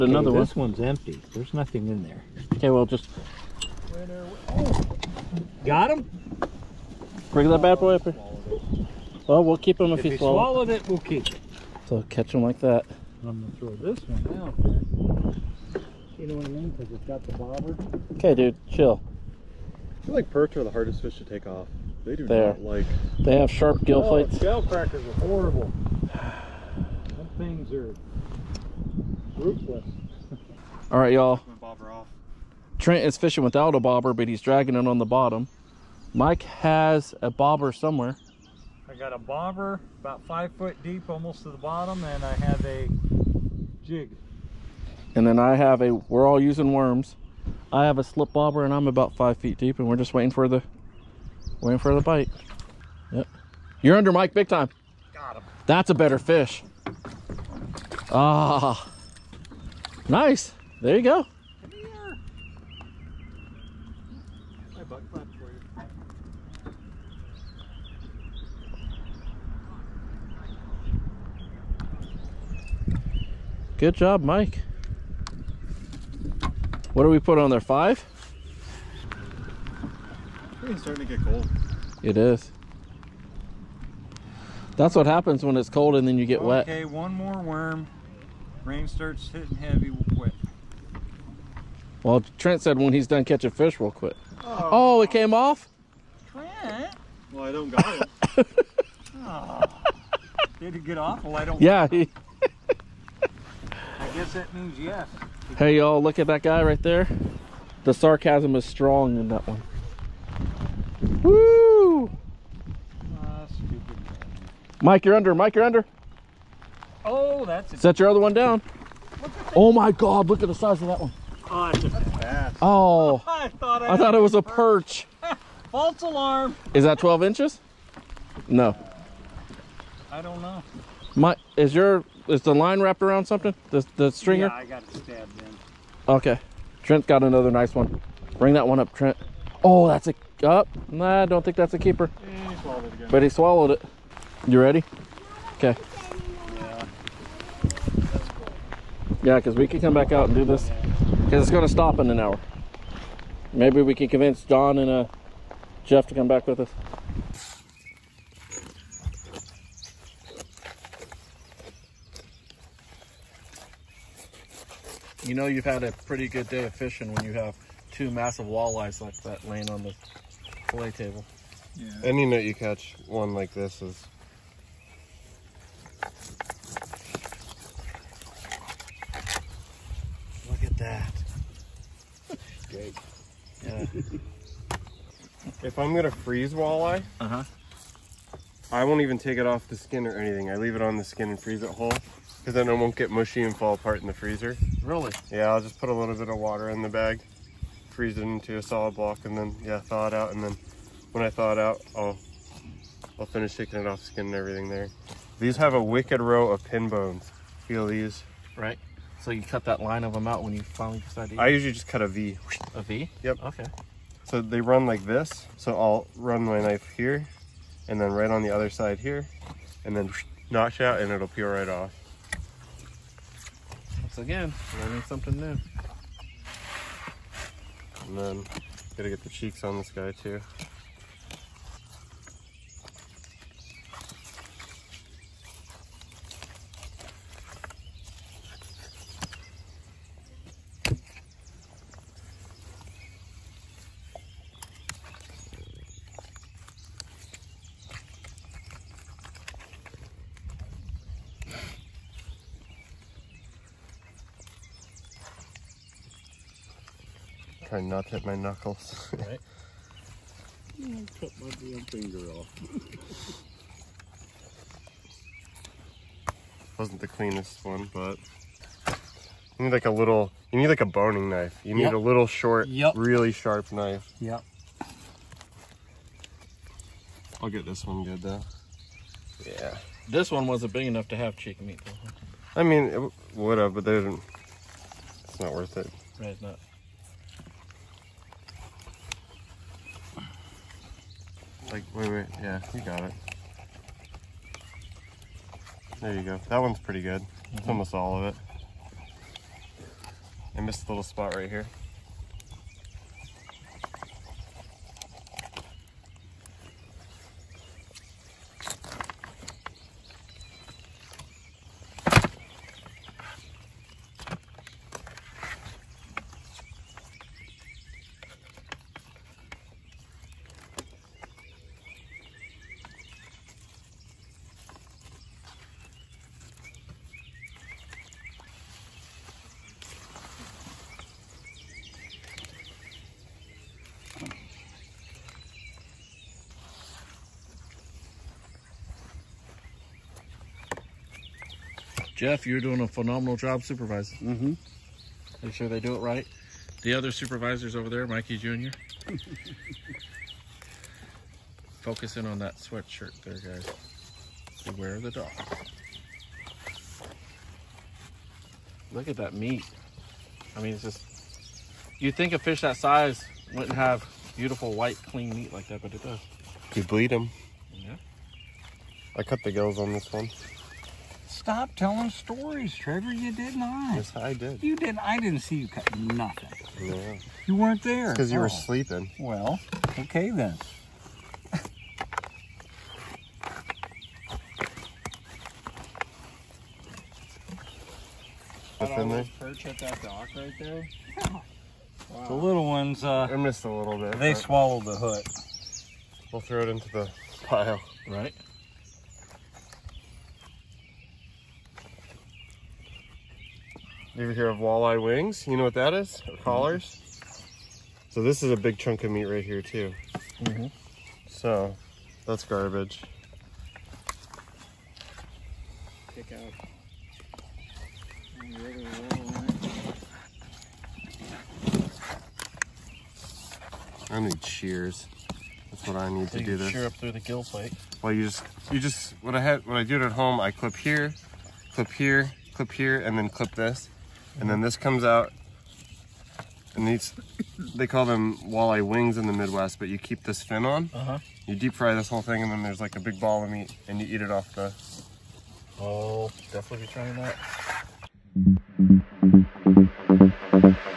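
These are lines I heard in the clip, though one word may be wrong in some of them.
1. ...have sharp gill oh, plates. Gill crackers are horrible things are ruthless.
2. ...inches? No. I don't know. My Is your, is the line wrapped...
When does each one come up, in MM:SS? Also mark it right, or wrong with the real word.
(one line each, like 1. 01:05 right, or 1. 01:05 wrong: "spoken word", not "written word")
1. 00:23 right
2. 02:07 right.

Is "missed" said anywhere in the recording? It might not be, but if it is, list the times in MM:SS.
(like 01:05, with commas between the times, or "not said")
05:00, 06:33.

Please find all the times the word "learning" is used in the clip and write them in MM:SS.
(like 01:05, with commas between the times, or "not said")
03:44.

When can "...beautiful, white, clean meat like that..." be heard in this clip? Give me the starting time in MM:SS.
06:04.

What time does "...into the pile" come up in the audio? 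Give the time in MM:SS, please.
06:36.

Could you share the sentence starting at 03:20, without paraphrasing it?
And then when I thaw it out, I'll, I'll finish taking it off skin and everything there.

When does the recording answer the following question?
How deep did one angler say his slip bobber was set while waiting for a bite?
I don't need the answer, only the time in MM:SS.
00:48.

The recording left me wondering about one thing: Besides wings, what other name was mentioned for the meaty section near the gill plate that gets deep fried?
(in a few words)
Collars.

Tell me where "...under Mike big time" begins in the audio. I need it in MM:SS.
00:53.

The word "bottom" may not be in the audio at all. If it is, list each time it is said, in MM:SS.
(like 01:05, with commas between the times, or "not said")
00:35, 00:41.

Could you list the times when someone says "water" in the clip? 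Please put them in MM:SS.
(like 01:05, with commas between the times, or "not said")
03:16.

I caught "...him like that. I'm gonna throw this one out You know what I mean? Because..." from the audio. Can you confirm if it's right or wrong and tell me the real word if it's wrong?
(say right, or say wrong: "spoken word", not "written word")
right.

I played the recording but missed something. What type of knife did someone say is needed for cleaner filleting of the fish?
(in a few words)
Boning knife.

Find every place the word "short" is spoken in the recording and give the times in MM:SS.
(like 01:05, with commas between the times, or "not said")
04:32.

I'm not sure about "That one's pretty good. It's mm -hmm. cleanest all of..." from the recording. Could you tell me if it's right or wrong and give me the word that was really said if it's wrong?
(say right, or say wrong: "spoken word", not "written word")
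wrong: "almost", not "cleanest".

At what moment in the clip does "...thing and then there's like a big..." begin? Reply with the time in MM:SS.
07:22.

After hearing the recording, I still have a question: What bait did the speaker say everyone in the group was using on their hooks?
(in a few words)
Worms.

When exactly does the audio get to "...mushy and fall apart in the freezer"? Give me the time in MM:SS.
03:13.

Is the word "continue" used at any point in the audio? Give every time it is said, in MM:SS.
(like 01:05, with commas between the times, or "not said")
not said.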